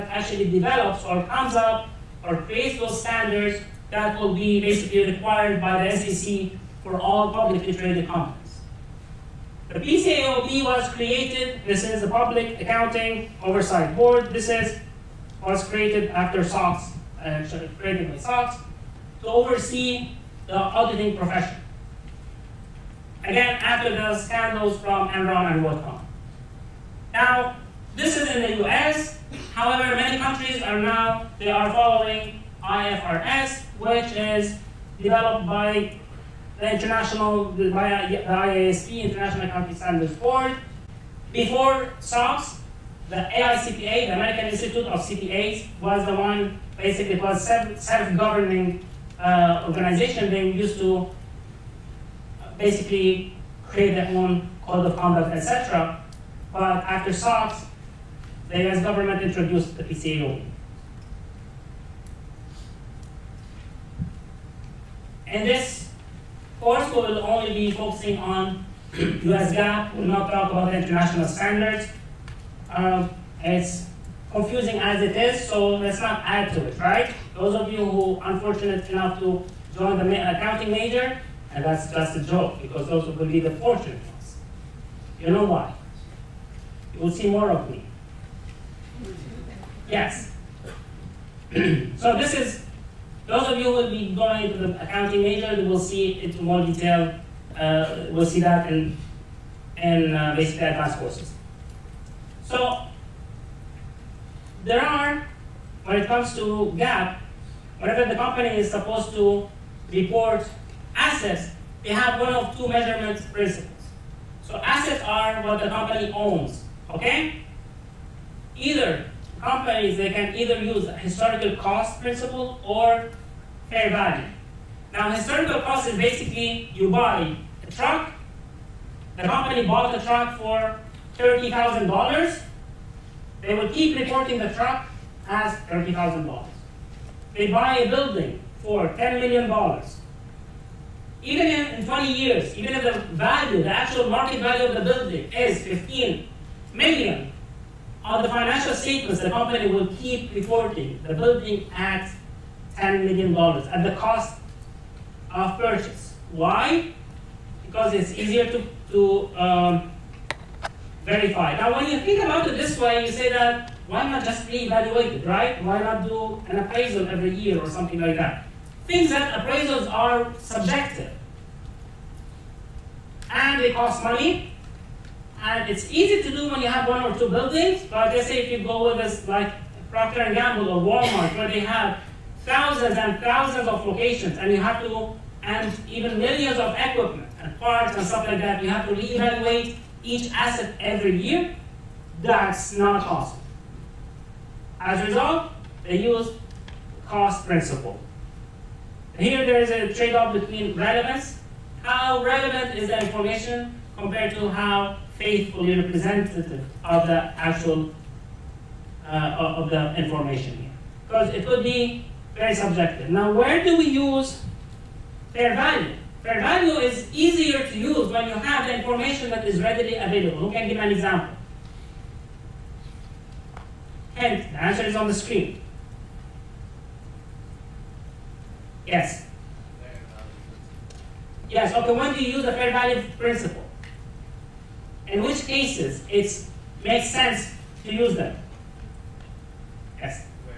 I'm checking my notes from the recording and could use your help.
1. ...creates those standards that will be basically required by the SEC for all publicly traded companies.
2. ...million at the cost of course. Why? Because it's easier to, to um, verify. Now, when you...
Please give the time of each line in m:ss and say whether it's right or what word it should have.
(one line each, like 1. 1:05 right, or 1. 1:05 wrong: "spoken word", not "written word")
1. 0:02 right
2. 2:33 wrong: "purchase", not "course".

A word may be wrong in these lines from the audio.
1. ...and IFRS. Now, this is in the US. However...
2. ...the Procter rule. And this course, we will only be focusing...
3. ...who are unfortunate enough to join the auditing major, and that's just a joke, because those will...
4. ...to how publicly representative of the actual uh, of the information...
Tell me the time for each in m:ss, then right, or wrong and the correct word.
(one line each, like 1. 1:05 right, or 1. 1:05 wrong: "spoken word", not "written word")
1. 0:25 wrong: "WorldCom", not "IFRS"
2. 0:59 wrong: "PCA", not "Procter"
3. 1:17 wrong: "accounting", not "auditing"
4. 3:24 wrong: "faithfully", not "publicly".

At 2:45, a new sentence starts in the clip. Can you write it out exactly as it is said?
Why not do an appraisal every year or something like that?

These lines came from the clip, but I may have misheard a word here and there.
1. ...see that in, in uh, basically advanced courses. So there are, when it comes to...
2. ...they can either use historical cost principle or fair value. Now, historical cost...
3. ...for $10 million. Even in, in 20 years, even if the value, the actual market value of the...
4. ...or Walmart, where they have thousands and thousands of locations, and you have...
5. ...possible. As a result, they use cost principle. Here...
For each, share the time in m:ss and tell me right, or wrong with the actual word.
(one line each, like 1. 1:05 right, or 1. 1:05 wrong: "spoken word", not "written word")
1. 1:38 right
2. 1:59 right
3. 2:18 right
4. 3:00 right
5. 3:13 right.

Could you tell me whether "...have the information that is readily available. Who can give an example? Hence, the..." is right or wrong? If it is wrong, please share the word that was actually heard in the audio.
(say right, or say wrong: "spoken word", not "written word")
right.